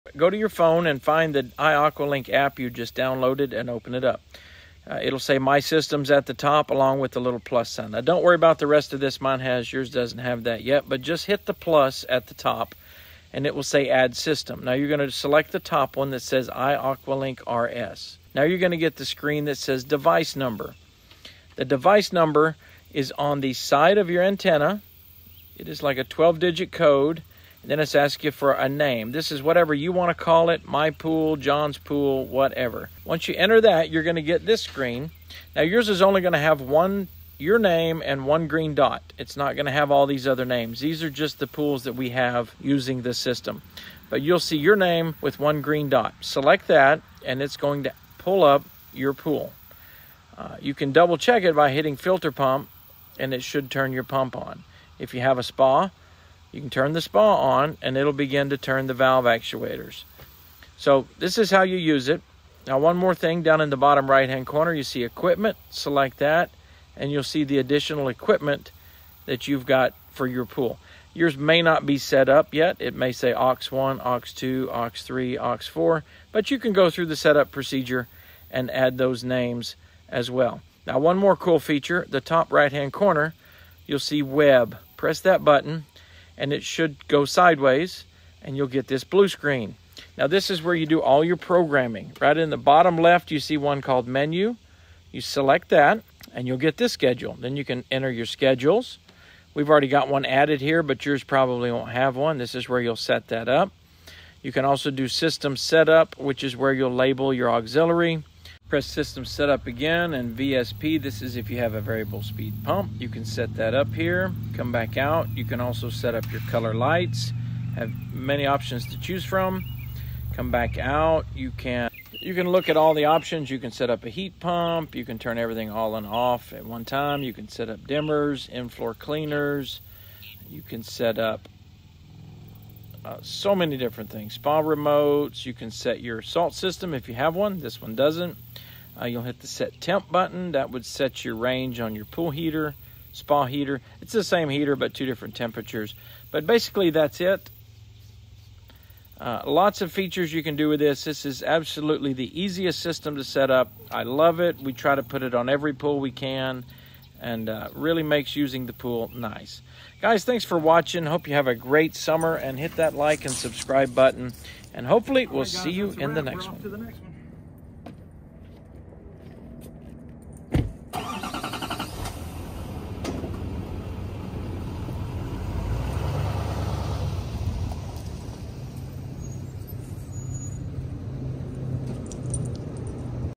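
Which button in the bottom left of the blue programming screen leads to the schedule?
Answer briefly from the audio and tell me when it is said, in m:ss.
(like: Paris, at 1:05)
Menu, at 1:34.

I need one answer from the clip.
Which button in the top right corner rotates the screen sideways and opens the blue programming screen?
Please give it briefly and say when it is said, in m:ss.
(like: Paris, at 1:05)
Web, at 1:24.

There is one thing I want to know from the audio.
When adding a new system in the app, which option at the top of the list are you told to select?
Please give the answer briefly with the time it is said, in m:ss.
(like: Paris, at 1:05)
iAqualink RS, at 0:16.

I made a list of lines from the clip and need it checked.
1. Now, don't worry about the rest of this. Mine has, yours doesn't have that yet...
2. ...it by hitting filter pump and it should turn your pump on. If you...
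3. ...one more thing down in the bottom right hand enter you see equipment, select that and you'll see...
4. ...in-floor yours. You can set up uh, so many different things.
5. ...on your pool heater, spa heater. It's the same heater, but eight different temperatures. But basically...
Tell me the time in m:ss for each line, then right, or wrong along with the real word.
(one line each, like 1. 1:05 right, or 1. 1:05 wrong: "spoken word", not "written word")
1. 0:07 right
2. 0:51 right
3. 1:02 wrong: "corner", not "enter"
4. 2:08 wrong: "cleaners", not "yours"
5. 2:21 wrong: "two", not "eight".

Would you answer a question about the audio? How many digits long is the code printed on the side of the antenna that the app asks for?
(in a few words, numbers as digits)
12.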